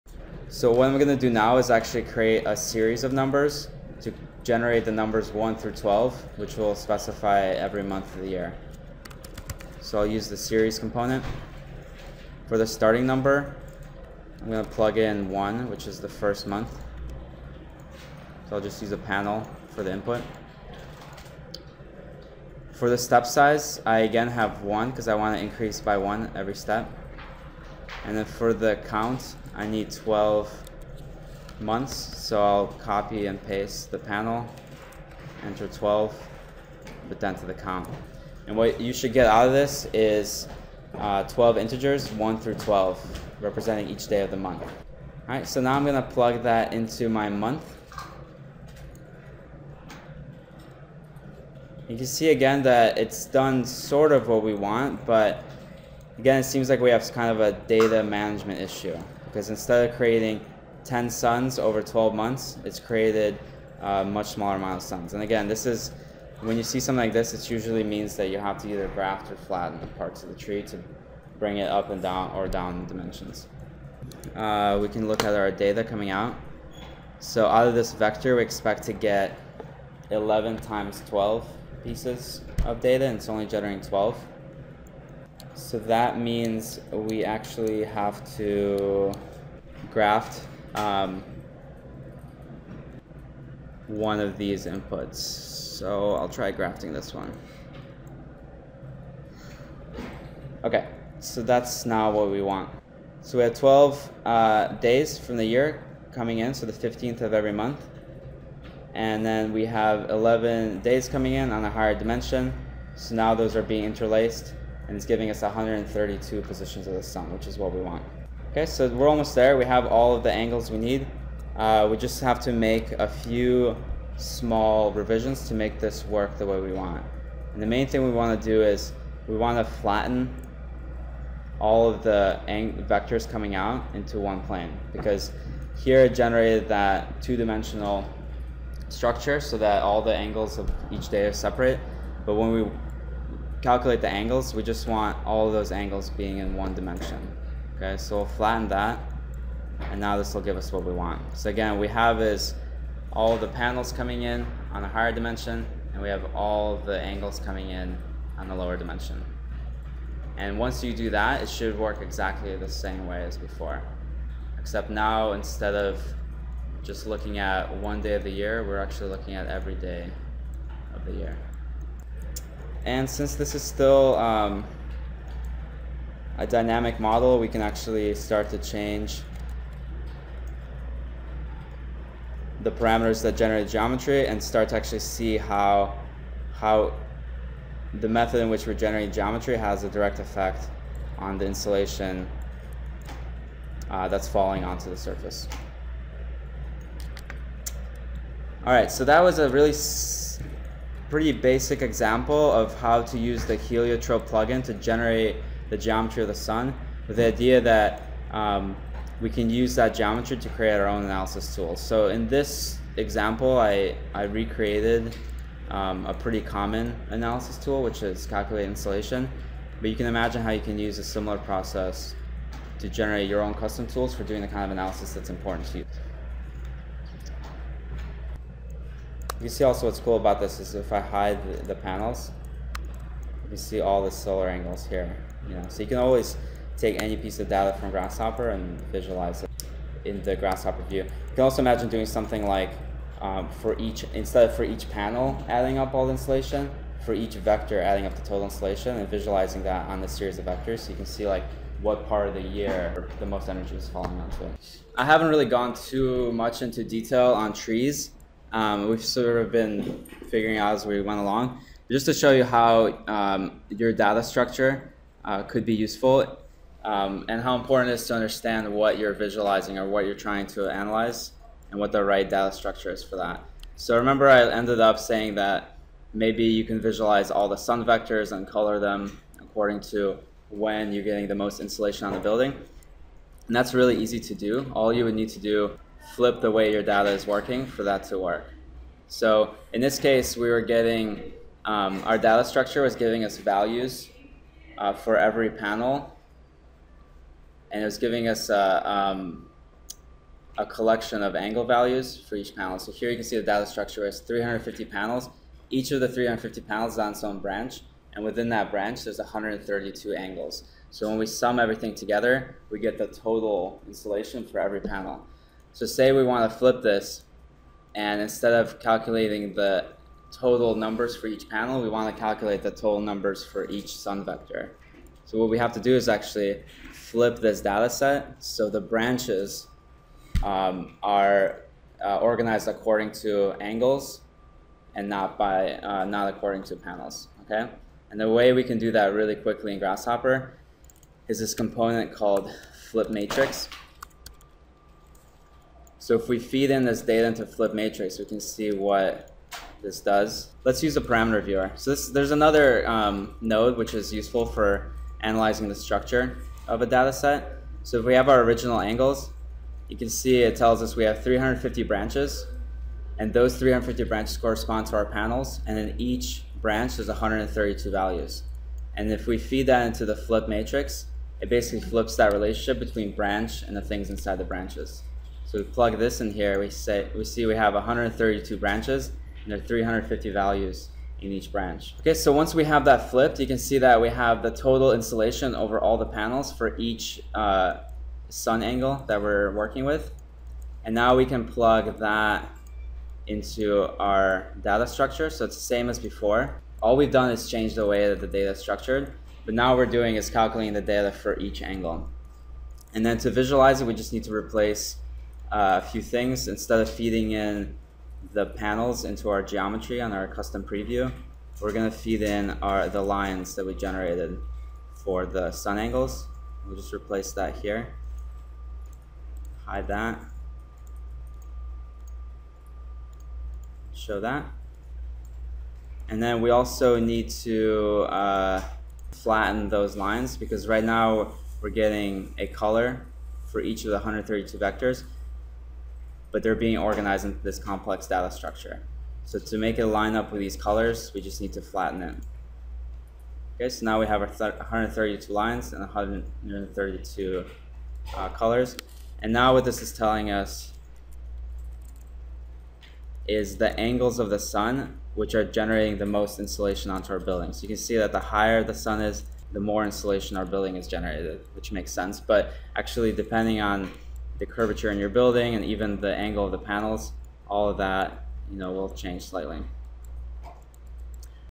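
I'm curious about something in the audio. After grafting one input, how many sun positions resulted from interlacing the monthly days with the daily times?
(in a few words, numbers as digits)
132.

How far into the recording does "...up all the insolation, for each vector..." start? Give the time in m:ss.
4:05.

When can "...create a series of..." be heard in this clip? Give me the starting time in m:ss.
0:02.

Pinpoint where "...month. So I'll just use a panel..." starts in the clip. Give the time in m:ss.
0:16.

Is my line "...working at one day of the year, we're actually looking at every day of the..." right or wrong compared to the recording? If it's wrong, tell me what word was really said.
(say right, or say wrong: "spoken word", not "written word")
wrong: "looking", not "working".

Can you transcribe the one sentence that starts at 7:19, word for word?
So to make it line up with these colors, we just need to flatten it.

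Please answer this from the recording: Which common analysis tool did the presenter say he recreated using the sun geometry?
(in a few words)
Calculate insolation.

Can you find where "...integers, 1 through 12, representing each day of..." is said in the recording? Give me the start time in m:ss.
0:41.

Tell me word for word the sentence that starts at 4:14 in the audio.
I haven't really gone too much into detail on trees.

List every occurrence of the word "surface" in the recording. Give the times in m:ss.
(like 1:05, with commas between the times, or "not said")
3:14.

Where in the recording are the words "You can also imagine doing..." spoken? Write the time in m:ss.
4:01.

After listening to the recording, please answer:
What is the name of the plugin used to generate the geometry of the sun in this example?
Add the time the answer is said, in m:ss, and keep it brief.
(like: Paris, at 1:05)
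Heliotrope, at 3:23.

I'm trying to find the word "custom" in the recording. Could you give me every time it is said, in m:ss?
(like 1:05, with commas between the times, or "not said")
3:43, 6:50.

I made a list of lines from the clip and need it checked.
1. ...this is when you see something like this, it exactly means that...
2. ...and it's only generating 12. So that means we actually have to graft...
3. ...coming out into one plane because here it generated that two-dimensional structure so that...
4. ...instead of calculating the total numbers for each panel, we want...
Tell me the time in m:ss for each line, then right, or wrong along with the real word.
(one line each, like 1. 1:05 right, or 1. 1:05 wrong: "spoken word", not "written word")
1. 1:05 wrong: "usually", not "exactly"
2. 1:23 right
3. 2:13 right
4. 5:18 right.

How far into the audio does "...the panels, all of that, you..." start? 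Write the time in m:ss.
7:46.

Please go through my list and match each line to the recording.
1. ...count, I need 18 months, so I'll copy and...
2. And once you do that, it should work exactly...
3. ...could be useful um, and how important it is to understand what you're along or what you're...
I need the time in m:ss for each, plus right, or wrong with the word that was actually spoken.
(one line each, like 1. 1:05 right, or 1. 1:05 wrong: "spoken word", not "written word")
1. 0:28 wrong: "12", not "18"
2. 2:40 right
3. 4:25 wrong: "visualizing", not "along".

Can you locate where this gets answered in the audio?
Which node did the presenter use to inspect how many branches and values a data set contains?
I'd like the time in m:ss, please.
5:51.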